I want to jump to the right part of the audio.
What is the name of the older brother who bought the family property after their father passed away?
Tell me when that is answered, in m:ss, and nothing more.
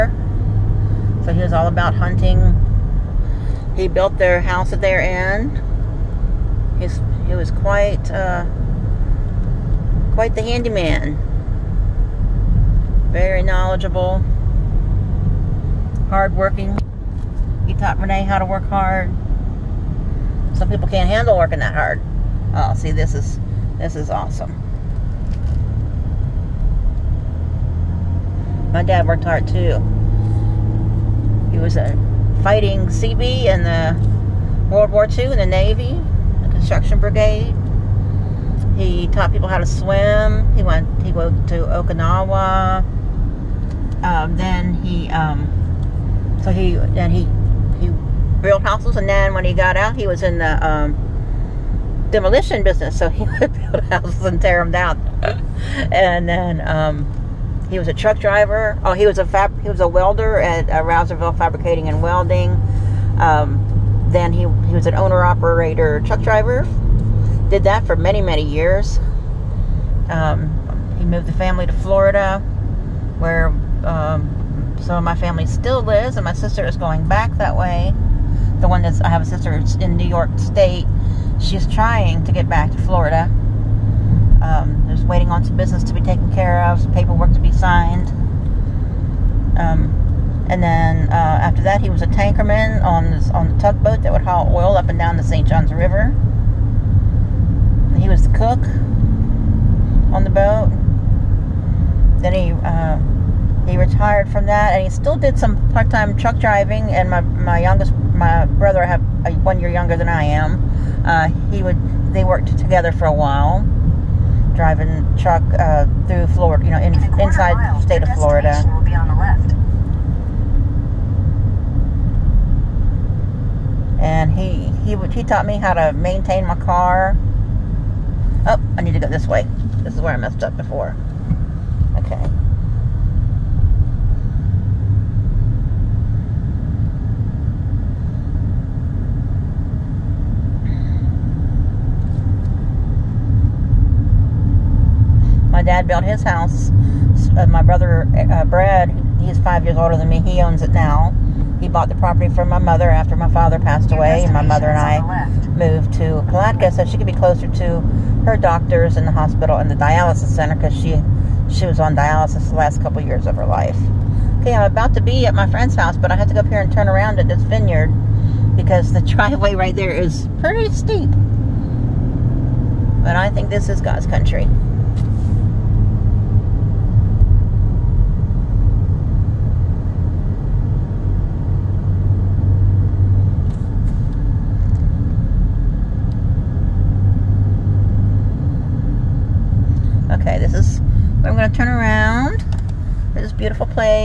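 2:28.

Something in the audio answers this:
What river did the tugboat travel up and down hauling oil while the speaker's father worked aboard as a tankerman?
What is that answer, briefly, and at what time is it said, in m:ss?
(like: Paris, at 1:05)
St. Johns River, at 1:35.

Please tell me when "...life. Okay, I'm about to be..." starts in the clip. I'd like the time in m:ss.
2:43.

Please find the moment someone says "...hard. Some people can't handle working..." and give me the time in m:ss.
0:18.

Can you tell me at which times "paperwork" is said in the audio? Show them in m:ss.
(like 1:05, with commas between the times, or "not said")
1:26.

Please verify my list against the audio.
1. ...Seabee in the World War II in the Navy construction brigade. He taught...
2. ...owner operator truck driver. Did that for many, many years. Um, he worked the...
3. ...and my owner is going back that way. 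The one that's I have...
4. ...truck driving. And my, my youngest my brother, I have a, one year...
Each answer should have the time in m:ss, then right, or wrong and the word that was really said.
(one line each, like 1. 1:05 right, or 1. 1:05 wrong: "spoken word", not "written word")
1. 0:32 right
2. 1:04 wrong: "moved", not "worked"
3. 1:16 wrong: "sister", not "owner"
4. 1:46 right.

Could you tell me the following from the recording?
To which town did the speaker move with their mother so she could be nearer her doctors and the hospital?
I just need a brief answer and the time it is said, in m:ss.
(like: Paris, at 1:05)
Palatka, at 2:36.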